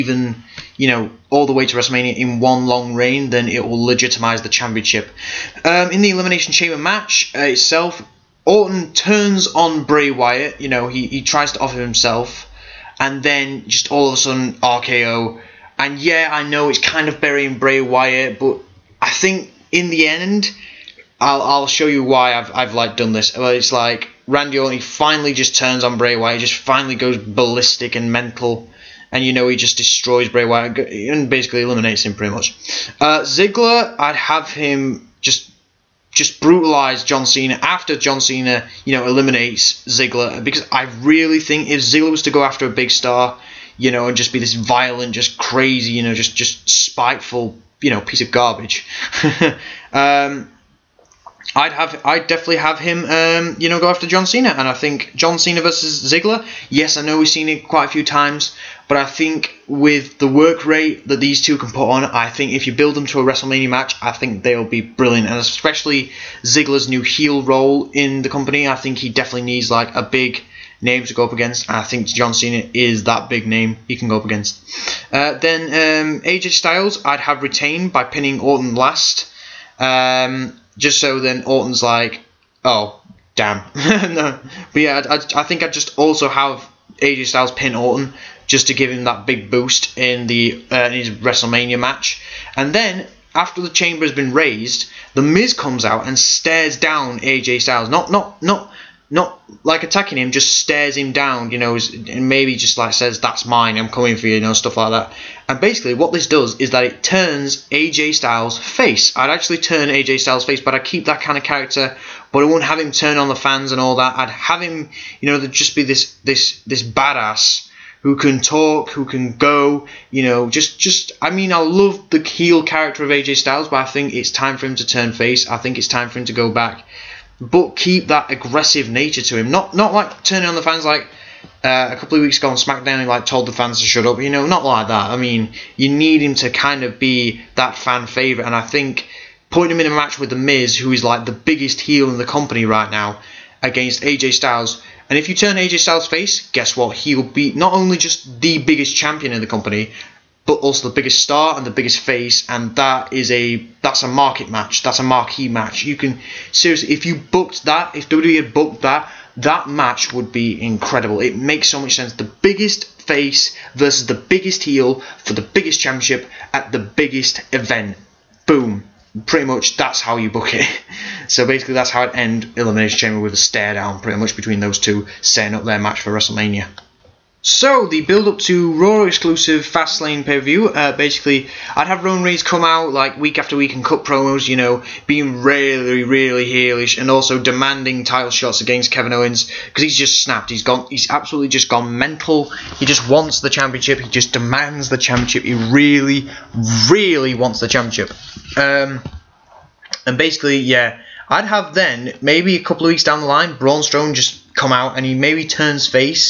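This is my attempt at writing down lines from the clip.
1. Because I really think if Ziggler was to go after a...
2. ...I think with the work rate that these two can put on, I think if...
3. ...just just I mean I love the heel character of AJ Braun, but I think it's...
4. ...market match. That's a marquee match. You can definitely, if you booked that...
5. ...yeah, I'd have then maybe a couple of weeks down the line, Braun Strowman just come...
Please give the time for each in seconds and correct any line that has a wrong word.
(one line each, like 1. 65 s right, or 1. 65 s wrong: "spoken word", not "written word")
1. 40 s right
2. 58 s right
3. 120 s wrong: "Styles", not "Braun"
4. 154 s wrong: "seriously", not "definitely"
5. 200 s right.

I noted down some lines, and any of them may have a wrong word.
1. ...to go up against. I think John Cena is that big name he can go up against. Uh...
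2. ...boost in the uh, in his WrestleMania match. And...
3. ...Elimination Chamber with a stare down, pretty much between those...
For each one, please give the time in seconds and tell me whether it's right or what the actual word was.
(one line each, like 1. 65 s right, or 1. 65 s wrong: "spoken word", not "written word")
1. 71 s right
2. 89 s right
3. 172 s right.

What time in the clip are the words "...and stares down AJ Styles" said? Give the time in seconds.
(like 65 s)
96 s.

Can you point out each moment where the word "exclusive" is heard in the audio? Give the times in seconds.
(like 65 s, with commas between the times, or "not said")
179 s.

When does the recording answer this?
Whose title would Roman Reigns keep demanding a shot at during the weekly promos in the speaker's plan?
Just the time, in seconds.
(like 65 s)
188 s.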